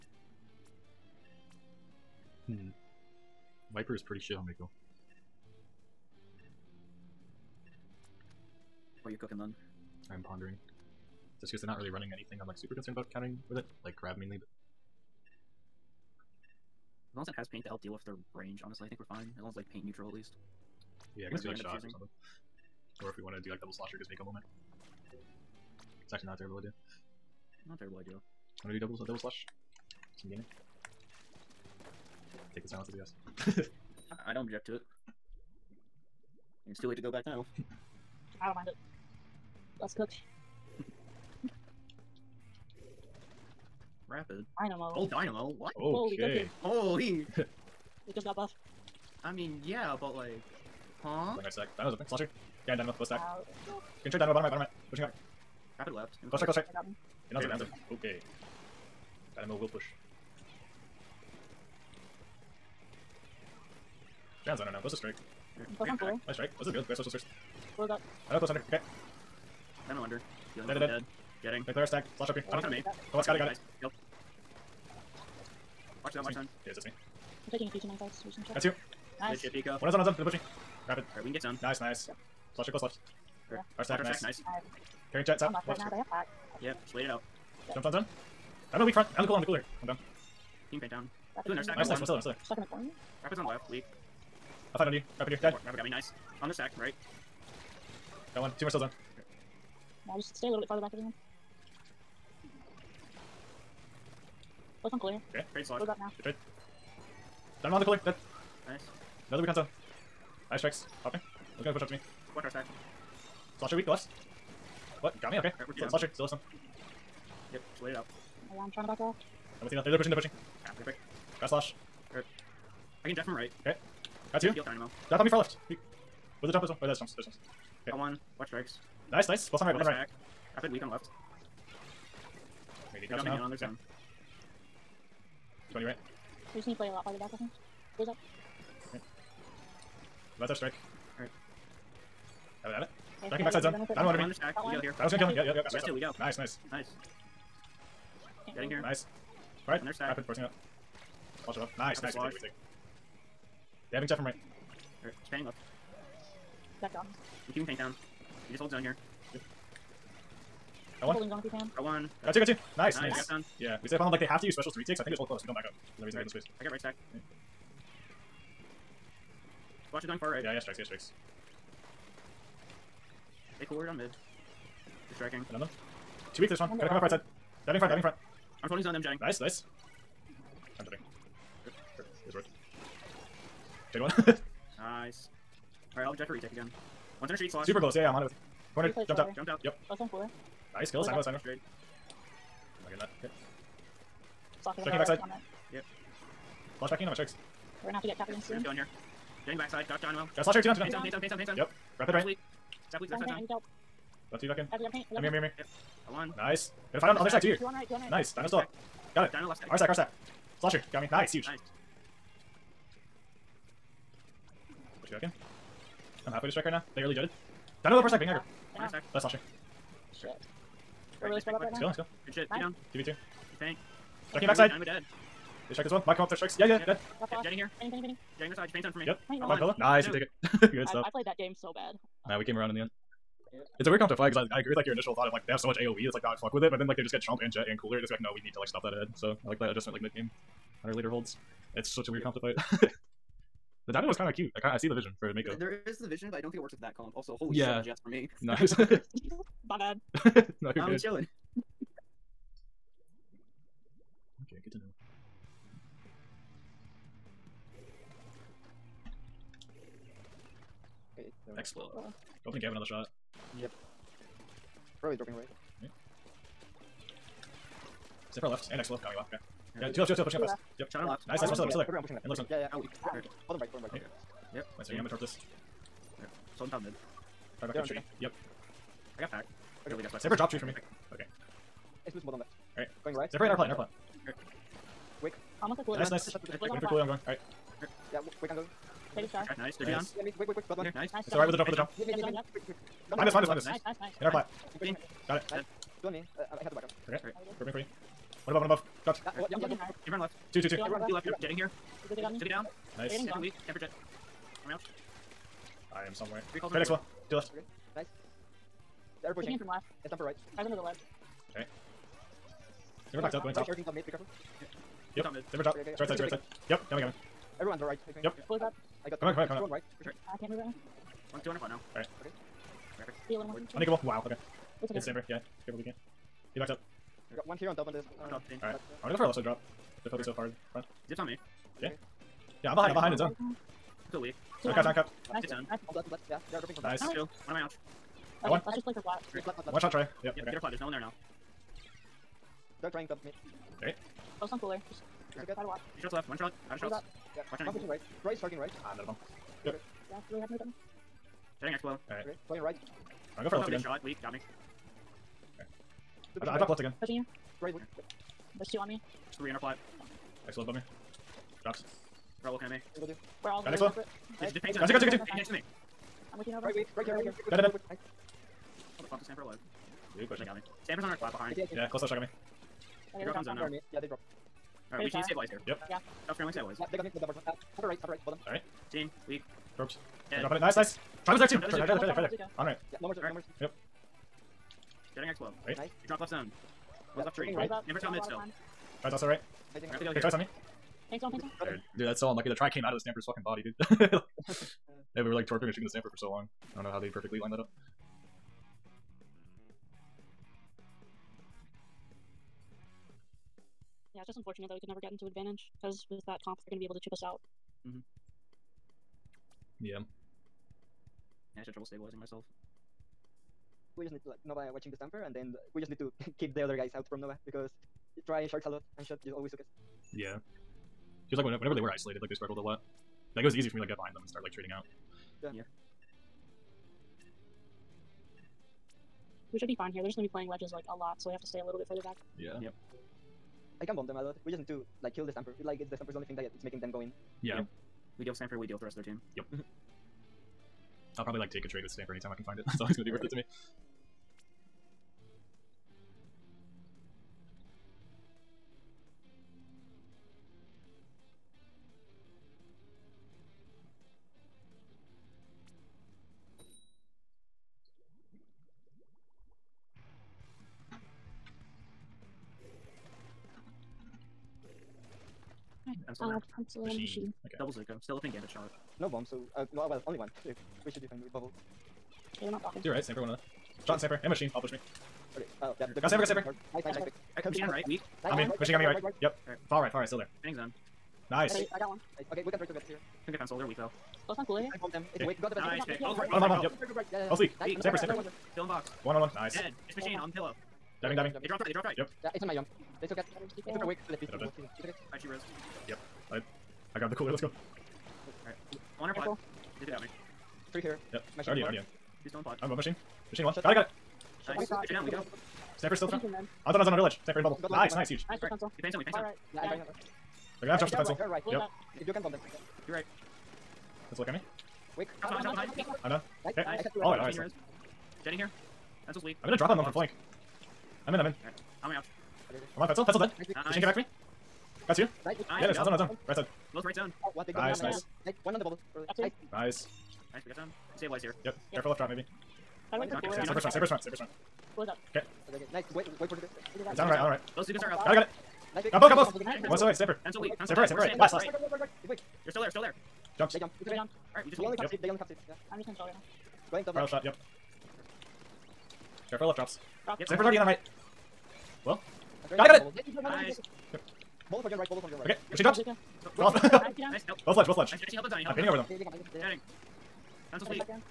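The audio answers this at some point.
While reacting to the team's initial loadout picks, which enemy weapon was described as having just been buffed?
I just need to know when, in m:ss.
0:44.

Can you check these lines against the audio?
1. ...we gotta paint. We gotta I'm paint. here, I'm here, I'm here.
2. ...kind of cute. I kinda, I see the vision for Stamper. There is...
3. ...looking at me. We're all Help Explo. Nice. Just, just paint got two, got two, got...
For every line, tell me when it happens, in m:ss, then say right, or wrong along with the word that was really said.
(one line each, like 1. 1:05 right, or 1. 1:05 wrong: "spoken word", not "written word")
1. 3:24 right
2. 4:04 wrong: "Mako", not "Stamper"
3. 6:02 wrong: "Got", not "Help".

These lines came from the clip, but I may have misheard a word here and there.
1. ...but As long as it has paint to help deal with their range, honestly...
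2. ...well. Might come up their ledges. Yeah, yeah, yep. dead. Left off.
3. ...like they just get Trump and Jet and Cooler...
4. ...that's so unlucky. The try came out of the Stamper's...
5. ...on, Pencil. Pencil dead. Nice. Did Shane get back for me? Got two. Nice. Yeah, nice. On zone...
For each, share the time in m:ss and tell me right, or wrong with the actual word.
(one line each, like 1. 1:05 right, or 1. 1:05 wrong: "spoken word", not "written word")
1. 0:14 right
2. 3:45 wrong: "strikes", not "ledges"
3. 3:56 right
4. 6:32 right
5. 8:42 right.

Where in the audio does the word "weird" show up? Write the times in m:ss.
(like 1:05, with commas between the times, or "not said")
3:53, 4:02.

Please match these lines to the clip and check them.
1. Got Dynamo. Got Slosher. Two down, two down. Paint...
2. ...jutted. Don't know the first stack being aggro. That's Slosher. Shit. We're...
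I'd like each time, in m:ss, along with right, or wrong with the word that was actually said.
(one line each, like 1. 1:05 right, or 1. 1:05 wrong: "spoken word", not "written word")
1. 3:19 right
2. 3:37 right.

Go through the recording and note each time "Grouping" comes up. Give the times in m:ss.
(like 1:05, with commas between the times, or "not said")
4:57.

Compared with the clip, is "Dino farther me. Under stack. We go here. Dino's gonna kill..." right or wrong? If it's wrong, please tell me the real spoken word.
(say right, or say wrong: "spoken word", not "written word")
wrong: "under", not "farther".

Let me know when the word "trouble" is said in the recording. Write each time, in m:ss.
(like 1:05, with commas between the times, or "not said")
6:51.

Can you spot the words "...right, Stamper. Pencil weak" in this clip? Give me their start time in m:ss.
8:59.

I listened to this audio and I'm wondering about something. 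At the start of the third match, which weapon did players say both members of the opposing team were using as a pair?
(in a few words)
Zuko.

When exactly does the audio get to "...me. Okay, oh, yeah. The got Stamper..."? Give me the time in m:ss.
7:54.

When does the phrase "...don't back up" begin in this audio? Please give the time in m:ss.
2:45.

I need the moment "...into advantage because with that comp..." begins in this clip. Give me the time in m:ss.
6:45.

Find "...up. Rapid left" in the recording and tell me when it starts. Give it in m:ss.
0:55.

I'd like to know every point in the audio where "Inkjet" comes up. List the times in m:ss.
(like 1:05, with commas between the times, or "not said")
2:34.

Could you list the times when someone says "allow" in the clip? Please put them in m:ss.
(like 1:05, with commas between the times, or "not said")
not said.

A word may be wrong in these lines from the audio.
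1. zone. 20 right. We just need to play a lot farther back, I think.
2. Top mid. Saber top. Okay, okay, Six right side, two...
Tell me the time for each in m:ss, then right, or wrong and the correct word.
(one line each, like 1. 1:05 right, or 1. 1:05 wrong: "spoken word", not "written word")
1. 2:13 right
2. 5:15 wrong: "Two", not "Six".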